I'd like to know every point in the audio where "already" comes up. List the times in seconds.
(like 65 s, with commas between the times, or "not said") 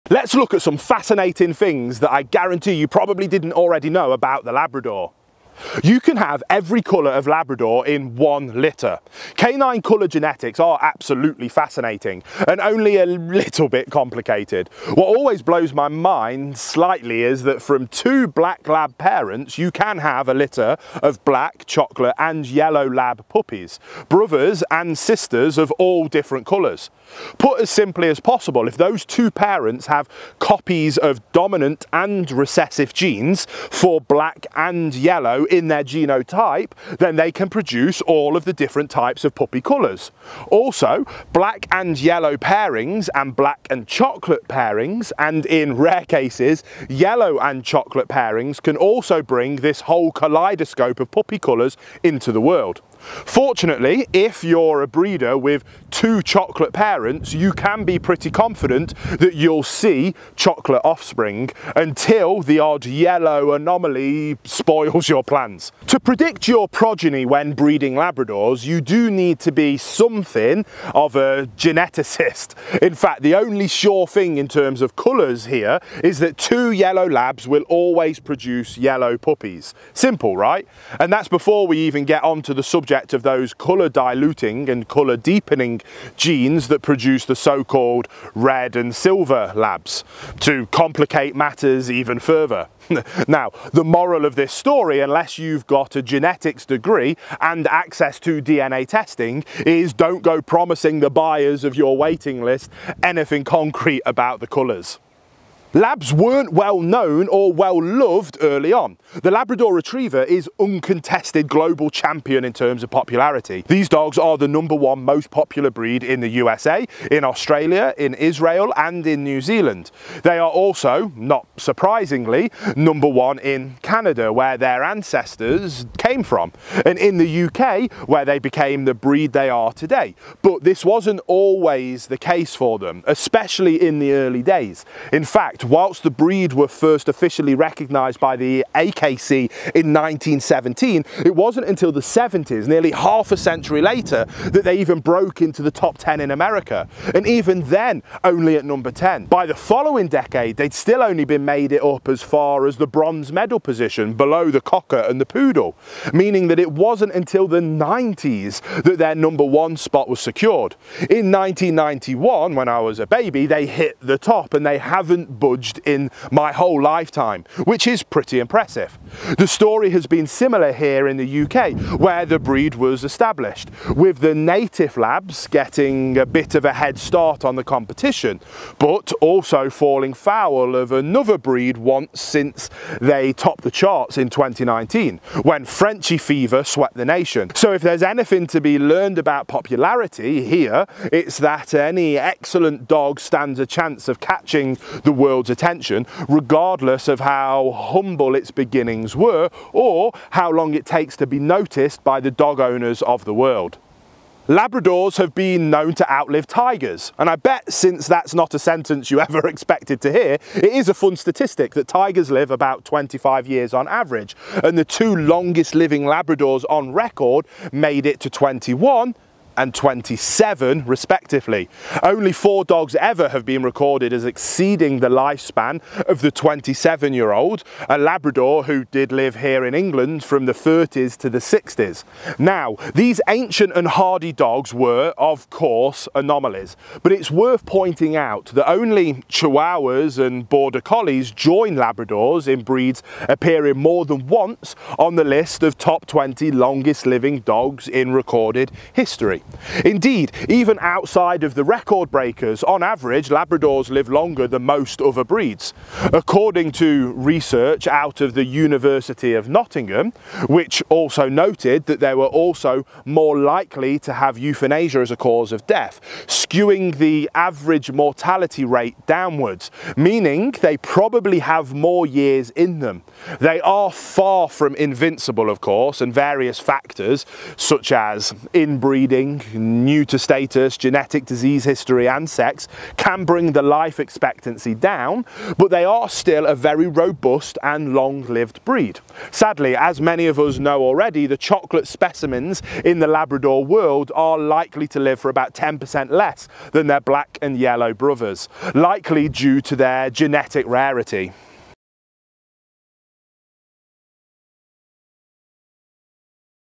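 3 s, 290 s.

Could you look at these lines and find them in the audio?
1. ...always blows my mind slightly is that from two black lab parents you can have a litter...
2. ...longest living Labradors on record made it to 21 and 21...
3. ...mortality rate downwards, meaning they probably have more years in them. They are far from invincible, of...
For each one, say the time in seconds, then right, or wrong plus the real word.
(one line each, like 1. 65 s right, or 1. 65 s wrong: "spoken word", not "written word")
1. 15 s right
2. 215 s wrong: "27", not "21"
3. 267 s right.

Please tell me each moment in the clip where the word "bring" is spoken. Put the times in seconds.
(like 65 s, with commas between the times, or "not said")
49 s, 283 s.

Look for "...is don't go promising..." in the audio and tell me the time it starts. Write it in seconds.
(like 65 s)
99 s.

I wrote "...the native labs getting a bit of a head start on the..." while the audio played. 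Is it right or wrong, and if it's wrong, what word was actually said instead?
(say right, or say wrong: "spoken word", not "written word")
right.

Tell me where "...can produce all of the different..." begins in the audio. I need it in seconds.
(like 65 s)
37 s.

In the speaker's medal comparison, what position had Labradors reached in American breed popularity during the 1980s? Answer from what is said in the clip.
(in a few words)
Bronze medal position.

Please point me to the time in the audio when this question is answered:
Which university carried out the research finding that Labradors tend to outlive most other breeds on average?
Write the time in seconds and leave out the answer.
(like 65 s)
258 s.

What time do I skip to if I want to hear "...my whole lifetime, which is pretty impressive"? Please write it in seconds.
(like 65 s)
166 s.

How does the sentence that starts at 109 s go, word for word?
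The Labrador Retriever is uncontested global champion in terms of popularity.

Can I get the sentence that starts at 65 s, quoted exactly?
To predict your progeny when breeding Labradors, you do need to be something of a geneticist.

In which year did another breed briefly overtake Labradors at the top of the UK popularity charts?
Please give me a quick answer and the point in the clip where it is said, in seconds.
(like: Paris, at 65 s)
2019, at 184 s.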